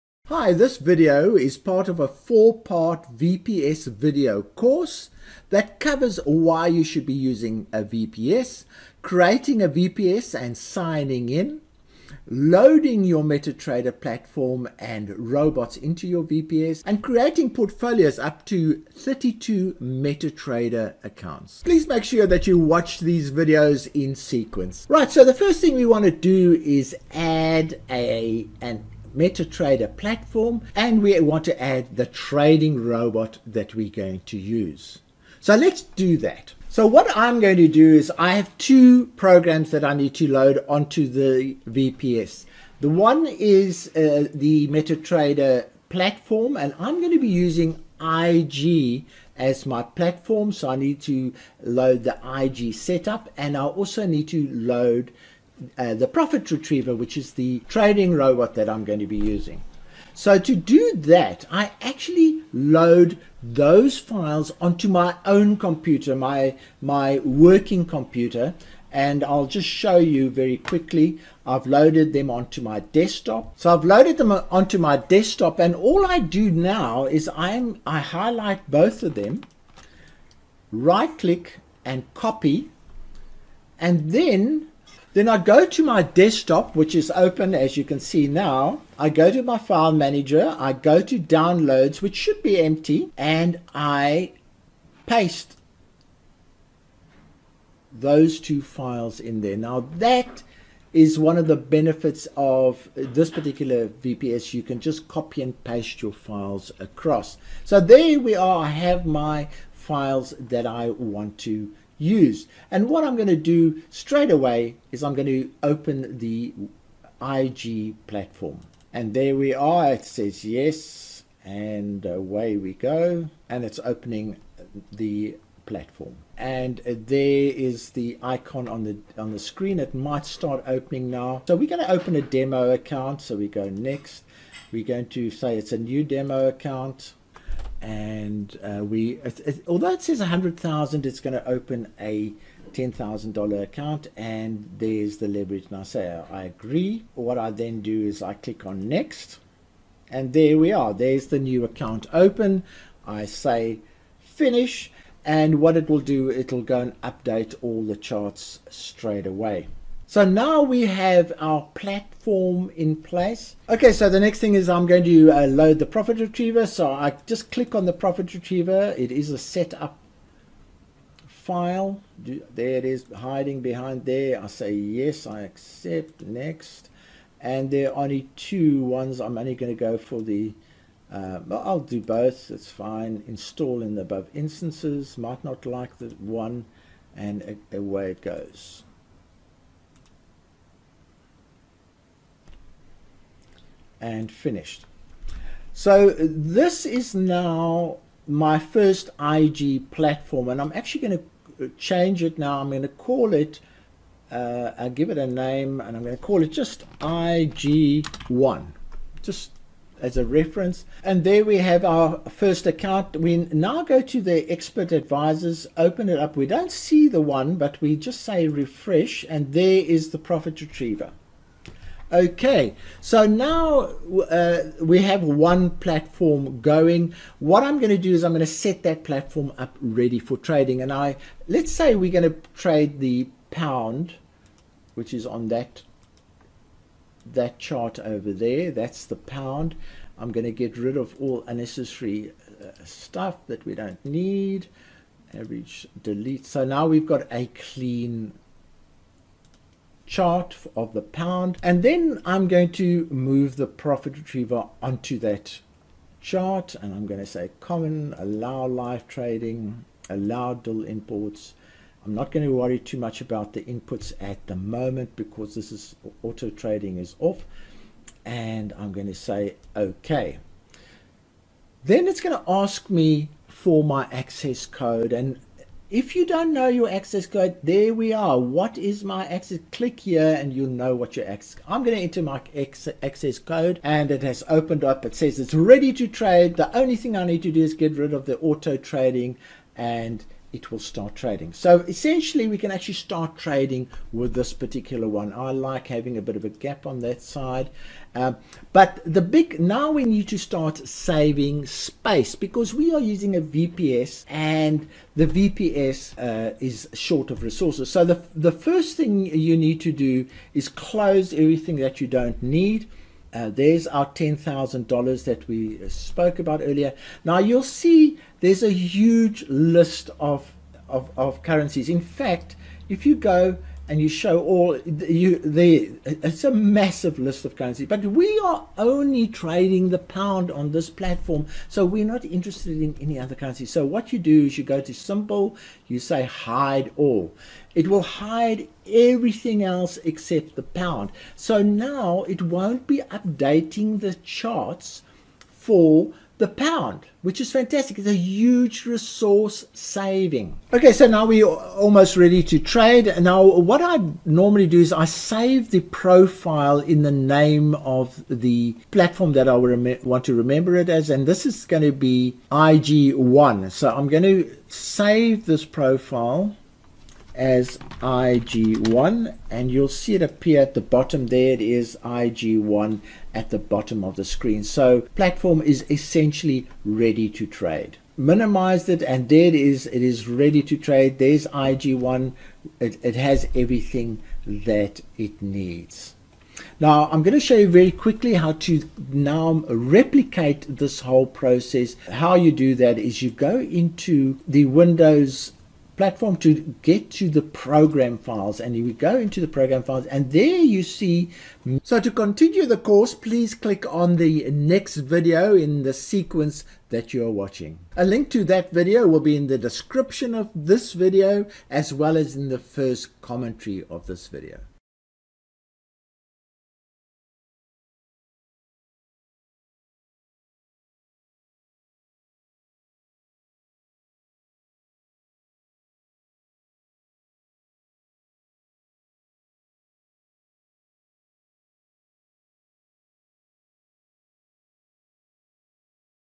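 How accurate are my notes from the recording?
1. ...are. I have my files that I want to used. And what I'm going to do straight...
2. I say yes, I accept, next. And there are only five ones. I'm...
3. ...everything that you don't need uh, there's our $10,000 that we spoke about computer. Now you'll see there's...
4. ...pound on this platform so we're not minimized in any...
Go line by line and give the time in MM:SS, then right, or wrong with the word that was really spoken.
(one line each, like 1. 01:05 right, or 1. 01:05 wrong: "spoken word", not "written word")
1. 01:48 right
2. 02:54 wrong: "two", not "five"
3. 05:11 wrong: "earlier", not "computer"
4. 05:29 wrong: "interested", not "minimized".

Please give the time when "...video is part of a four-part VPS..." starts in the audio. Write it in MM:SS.
00:00.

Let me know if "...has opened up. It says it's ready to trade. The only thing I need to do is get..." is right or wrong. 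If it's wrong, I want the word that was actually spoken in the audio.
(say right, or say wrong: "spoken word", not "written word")
right.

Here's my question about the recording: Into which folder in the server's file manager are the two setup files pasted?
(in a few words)
Downloads.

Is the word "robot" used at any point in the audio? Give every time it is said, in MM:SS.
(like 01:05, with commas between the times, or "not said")
00:15, 00:32, 00:58.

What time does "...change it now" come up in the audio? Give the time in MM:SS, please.
03:21.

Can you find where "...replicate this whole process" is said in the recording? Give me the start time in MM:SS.
06:29.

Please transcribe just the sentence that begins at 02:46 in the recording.
So I just click on the profit retriever.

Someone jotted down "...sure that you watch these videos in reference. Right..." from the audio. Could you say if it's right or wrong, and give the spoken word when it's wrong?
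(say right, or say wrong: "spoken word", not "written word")
wrong: "sequence", not "reference".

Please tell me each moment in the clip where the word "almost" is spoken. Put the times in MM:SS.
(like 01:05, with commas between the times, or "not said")
05:51.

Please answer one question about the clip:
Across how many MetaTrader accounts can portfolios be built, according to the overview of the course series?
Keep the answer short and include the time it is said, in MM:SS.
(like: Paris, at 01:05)
32, at 00:18.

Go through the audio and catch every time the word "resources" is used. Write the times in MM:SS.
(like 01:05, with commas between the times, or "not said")
05:07, 05:48.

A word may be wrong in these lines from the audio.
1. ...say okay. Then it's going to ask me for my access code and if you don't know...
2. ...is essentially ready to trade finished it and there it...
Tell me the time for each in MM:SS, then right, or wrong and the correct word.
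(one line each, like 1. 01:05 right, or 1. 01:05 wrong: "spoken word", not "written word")
1. 04:29 right
2. 06:15 wrong: "minimized", not "finished".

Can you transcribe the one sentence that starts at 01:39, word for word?
Now that is one of the benefits of this particular VPS.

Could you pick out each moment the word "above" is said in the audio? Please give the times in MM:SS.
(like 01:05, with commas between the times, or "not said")
03:04.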